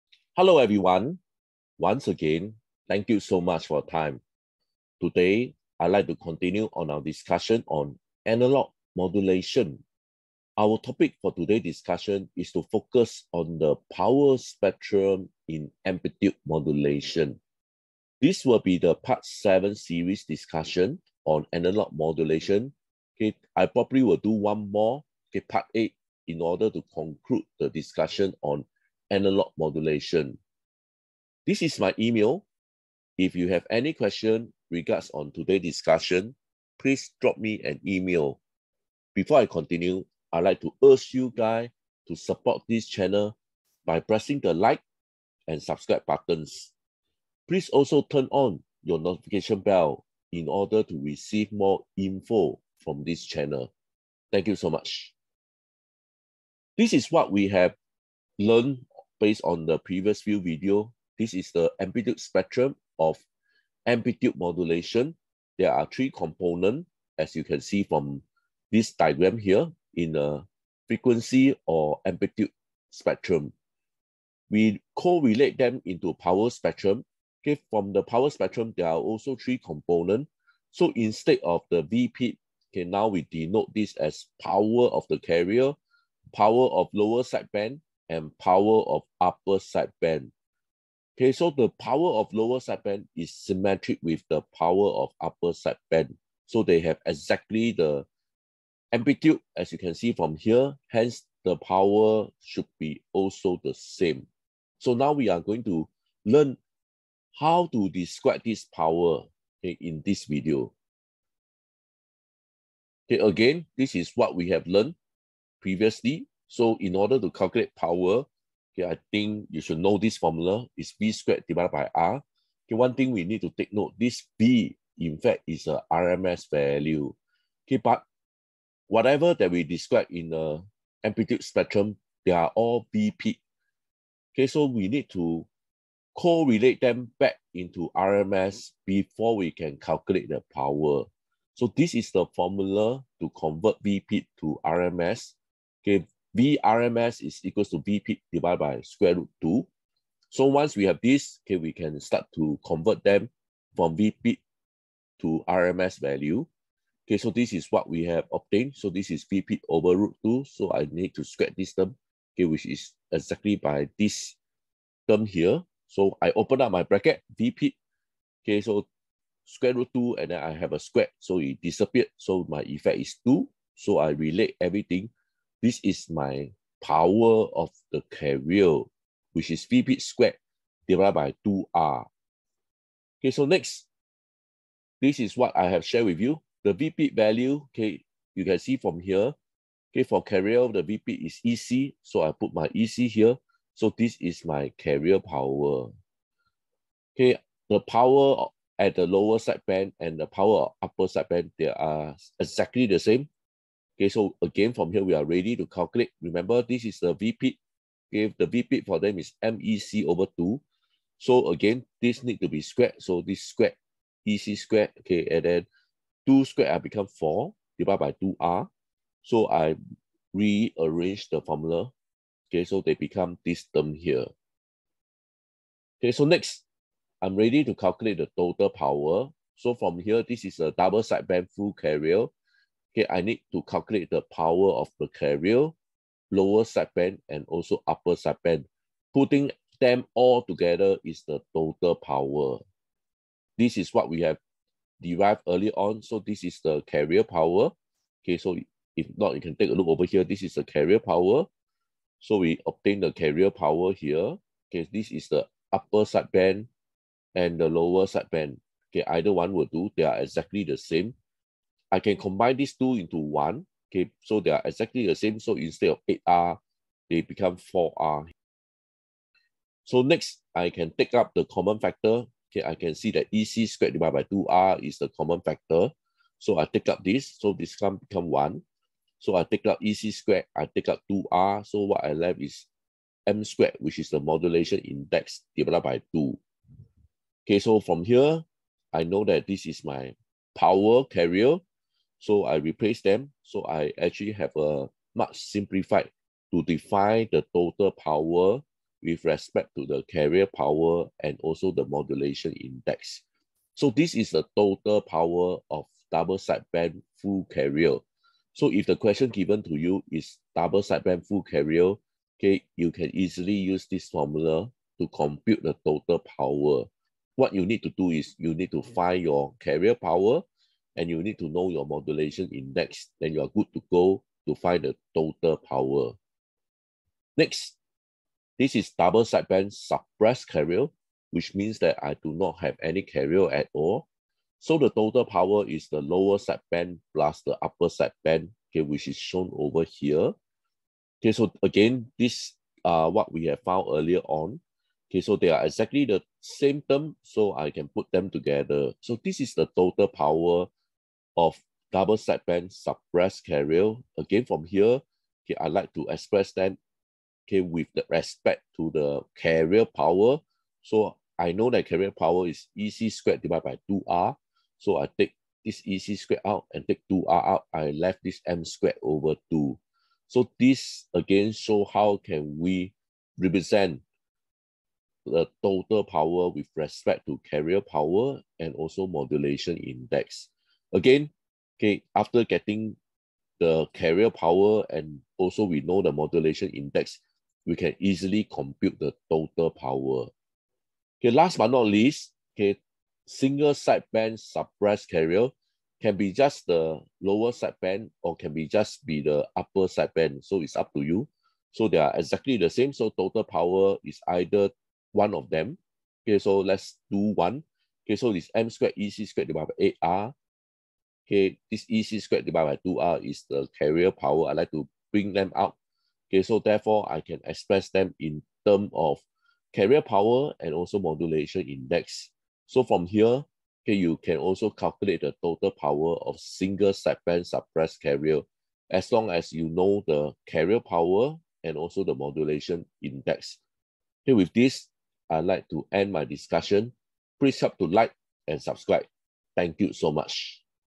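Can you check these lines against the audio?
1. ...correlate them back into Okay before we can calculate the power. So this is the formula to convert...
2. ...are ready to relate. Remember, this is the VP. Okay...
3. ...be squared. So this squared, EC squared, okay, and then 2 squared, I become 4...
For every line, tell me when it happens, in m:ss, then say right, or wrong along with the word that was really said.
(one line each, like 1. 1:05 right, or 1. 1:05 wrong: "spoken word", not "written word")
1. 2:16 wrong: "RMS", not "Okay"
2. 3:25 wrong: "calculate", not "relate"
3. 3:32 right.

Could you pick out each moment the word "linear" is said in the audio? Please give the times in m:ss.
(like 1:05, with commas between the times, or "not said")
not said.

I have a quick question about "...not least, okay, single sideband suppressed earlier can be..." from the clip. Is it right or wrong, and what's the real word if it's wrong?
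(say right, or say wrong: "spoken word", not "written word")
wrong: "carrier", not "earlier".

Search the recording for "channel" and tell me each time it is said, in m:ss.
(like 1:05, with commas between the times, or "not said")
0:42, 0:53.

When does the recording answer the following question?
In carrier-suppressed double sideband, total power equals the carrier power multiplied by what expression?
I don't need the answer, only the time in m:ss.
6:08.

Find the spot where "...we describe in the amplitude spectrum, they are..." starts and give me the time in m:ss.
2:09.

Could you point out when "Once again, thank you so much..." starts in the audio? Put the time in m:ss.
0:01.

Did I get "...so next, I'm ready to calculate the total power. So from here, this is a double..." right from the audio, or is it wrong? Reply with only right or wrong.
right.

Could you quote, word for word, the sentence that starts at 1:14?
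We correlate them into power spectrum.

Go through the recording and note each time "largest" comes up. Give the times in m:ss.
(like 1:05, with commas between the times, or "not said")
not said.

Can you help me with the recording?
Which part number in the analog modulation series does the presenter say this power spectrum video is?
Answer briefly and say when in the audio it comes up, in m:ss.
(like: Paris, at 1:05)
Part 7, at 0:18.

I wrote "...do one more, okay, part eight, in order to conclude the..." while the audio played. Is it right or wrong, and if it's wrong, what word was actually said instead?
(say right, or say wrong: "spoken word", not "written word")
right.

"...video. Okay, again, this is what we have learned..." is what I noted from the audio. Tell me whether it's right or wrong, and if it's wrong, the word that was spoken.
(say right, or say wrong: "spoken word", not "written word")
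right.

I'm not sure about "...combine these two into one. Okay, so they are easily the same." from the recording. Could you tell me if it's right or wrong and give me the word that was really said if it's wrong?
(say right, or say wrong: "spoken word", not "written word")
wrong: "exactly", not "easily".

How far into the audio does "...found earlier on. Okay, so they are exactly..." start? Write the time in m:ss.
5:43.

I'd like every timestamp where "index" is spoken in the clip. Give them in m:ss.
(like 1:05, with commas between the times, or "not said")
4:44, 5:02, 5:22, 6:19, 6:26, 7:01, 7:13.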